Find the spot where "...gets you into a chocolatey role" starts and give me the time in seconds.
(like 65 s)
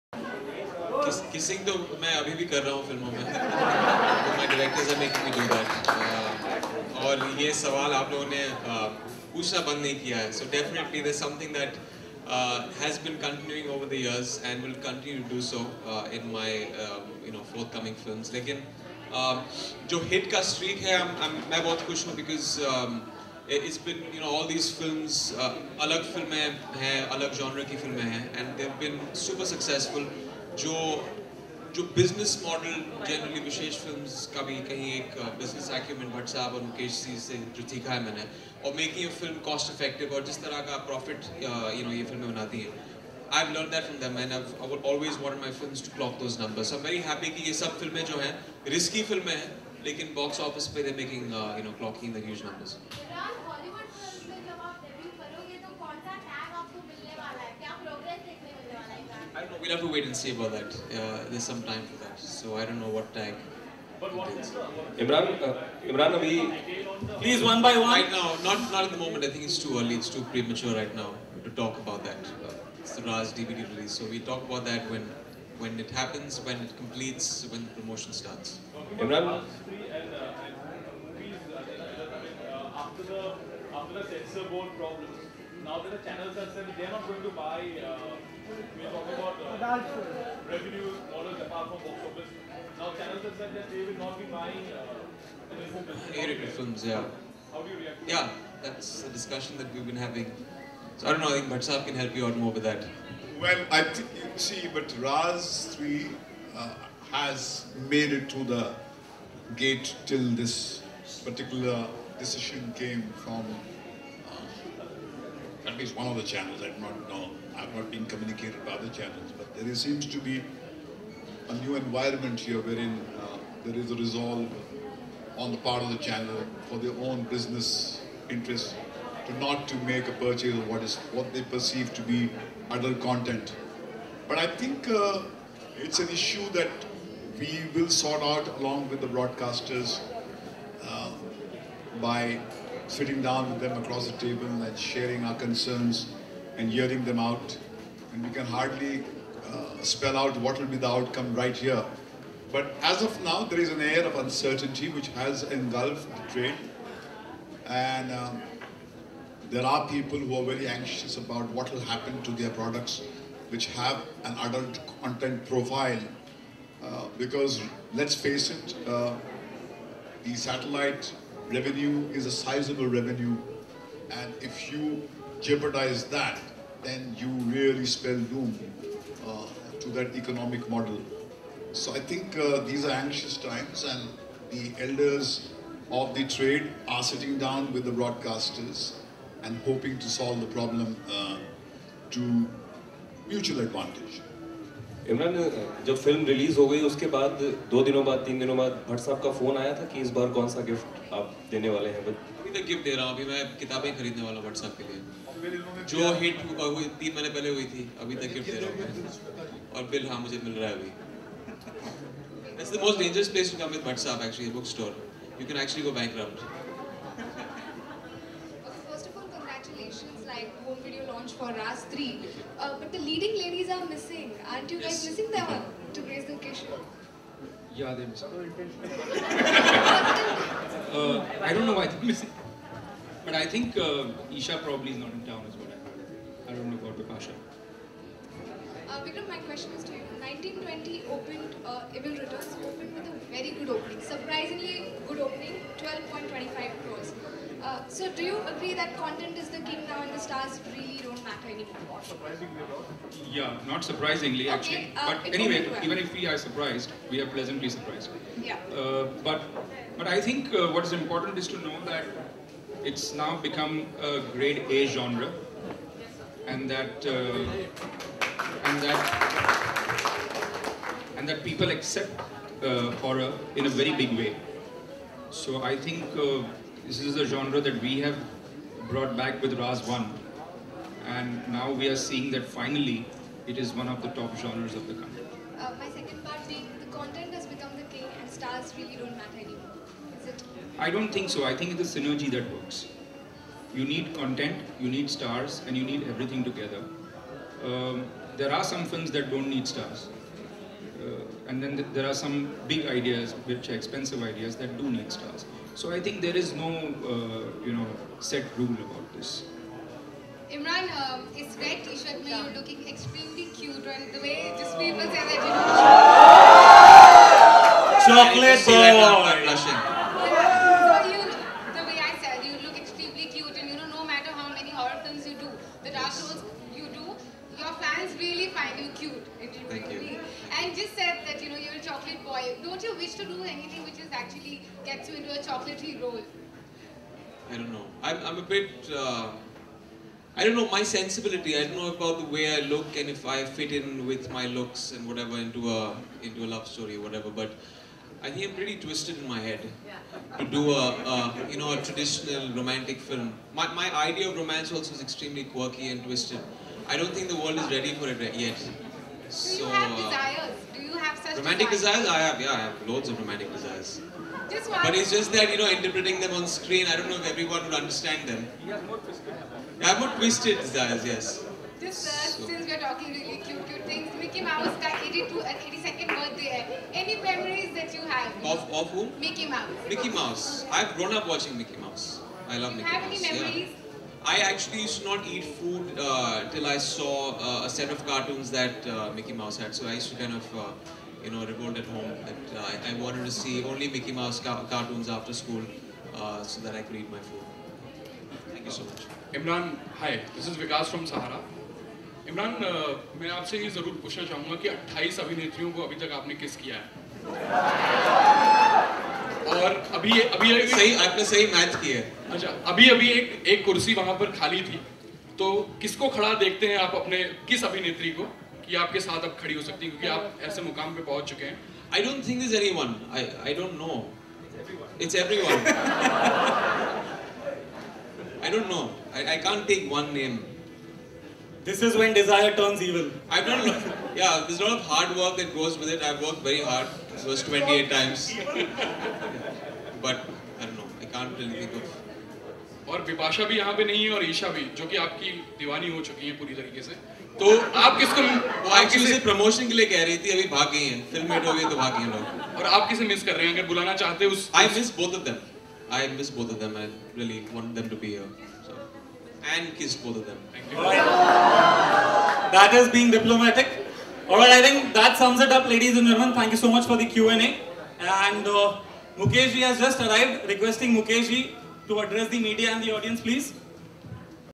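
334 s.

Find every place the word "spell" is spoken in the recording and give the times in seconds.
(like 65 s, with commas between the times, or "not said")
149 s, 177 s.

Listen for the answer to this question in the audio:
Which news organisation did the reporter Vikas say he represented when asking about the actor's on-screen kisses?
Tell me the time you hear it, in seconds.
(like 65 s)
401 s.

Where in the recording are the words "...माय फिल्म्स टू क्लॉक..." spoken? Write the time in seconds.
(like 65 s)
45 s.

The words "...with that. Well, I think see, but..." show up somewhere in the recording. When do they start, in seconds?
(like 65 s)
102 s.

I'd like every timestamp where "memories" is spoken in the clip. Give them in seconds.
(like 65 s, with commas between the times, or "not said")
377 s, 383 s.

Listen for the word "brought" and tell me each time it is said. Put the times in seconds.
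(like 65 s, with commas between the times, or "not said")
278 s.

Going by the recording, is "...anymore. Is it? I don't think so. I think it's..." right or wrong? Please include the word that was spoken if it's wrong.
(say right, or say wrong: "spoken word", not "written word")
right.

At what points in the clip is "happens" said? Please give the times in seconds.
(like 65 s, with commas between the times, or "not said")
75 s, 161 s.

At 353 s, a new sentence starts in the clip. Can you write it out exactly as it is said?
My my idea of romance also is extremely quirky and twisted.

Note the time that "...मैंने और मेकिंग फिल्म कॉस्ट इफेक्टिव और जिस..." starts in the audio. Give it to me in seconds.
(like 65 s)
38 s.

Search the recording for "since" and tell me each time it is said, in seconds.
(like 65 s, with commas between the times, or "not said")
372 s.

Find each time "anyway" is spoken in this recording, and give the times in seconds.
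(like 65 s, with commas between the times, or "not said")
255 s.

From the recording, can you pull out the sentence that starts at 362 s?
Yeah, I have loads of romantic desires.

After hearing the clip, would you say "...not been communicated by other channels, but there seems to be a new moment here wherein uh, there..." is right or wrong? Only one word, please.
wrong.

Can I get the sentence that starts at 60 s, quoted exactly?
Uh, there's some time for that.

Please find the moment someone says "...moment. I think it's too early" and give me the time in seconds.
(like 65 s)
68 s.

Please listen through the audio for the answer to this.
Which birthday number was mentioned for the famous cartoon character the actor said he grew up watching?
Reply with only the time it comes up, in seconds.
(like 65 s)
375 s.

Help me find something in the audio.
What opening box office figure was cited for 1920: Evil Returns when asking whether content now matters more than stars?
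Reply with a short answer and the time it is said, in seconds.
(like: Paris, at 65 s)
12.25 crores, at 245 s.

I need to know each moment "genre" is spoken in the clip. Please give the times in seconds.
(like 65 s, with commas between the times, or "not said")
264 s, 277 s, 284 s.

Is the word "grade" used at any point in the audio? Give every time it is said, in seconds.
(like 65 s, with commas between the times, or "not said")
264 s.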